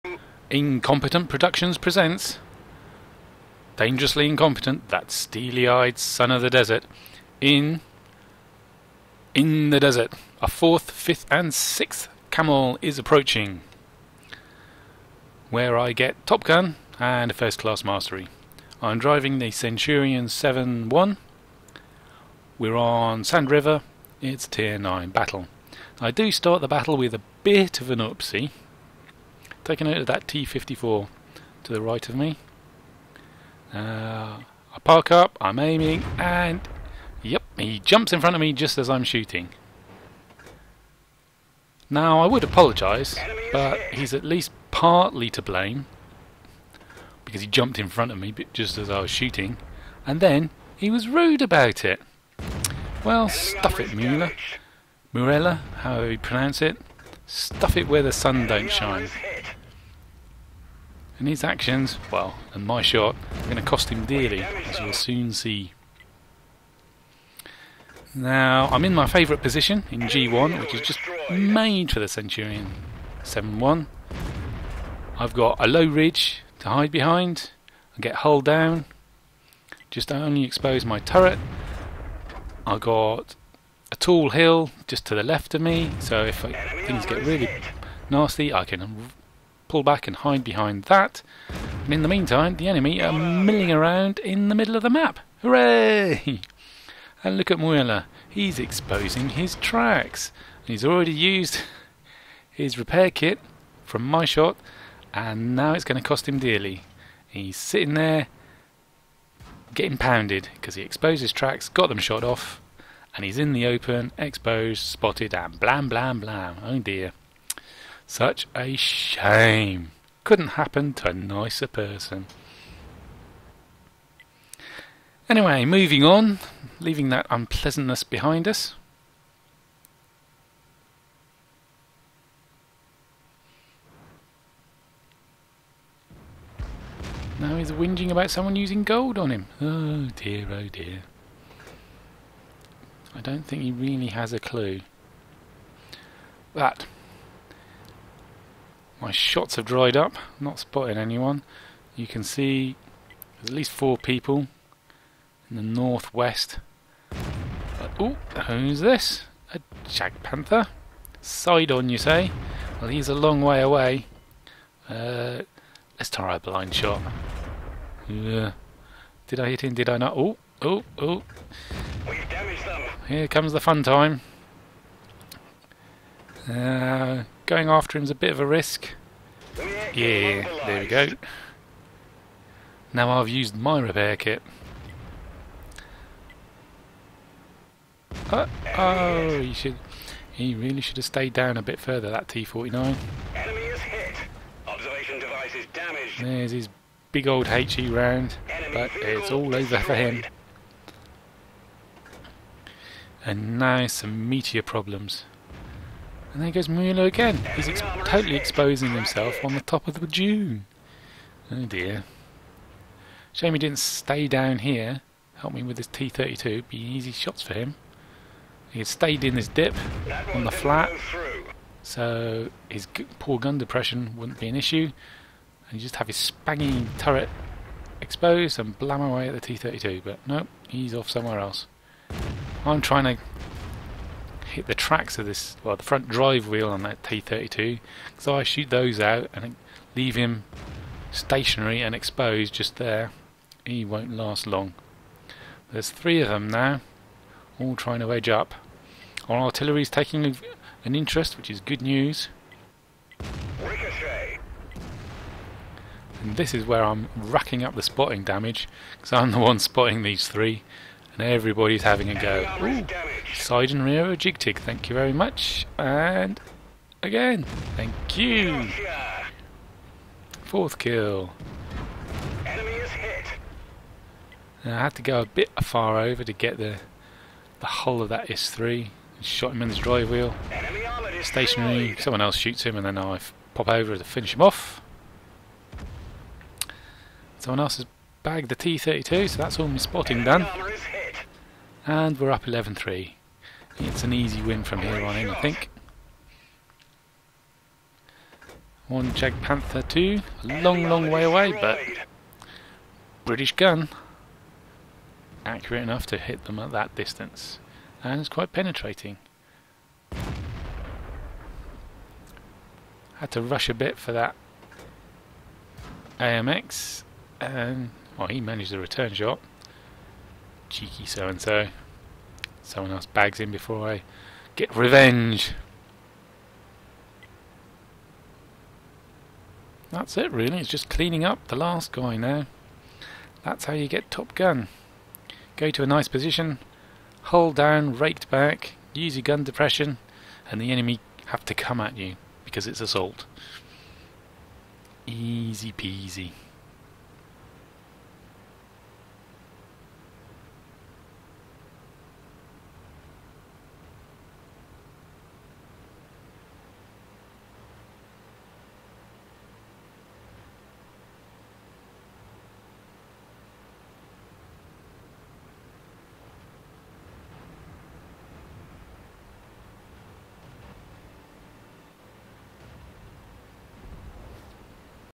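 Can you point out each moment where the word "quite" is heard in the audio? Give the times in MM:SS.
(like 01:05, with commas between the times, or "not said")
05:08.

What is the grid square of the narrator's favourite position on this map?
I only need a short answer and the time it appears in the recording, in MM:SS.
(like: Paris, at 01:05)
G1, at 01:10.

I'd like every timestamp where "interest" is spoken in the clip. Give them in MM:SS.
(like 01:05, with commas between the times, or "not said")
04:10.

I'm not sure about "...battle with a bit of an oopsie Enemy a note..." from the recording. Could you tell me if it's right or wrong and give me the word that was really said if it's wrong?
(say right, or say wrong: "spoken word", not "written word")
wrong: "Take", not "Enemy".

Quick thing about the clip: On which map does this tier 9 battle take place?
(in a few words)
Sand River.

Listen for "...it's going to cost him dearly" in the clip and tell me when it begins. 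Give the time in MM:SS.
01:45.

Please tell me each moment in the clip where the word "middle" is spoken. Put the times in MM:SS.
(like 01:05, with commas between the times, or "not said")
01:34.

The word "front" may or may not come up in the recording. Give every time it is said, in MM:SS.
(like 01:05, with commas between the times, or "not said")
00:38, 00:47, 03:55.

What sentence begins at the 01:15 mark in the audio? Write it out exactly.
I've got a low ridge to hide behind, I get hull down, just only expose my turret.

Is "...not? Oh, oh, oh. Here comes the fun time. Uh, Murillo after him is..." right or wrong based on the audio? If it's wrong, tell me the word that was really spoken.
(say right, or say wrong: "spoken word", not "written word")
wrong: "Going", not "Murillo".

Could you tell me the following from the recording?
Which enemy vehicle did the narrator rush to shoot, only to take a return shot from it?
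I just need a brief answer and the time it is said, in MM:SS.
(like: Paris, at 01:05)
AMX, at 05:16.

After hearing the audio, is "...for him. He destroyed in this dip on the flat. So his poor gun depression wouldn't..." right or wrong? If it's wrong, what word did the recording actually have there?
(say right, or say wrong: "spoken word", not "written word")
wrong: "stayed", not "destroyed".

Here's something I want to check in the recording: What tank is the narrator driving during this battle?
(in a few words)
Centurion 7/1.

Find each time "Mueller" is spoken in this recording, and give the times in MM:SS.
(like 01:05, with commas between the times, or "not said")
00:53, 01:37.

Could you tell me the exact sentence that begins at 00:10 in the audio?
A fourth, fifth, and sixth camel is approaching.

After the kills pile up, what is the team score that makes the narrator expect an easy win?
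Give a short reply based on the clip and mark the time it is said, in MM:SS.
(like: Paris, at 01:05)
11-3, at 04:52.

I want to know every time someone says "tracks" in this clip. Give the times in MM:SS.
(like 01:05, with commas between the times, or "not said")
01:39, 01:51, 03:54.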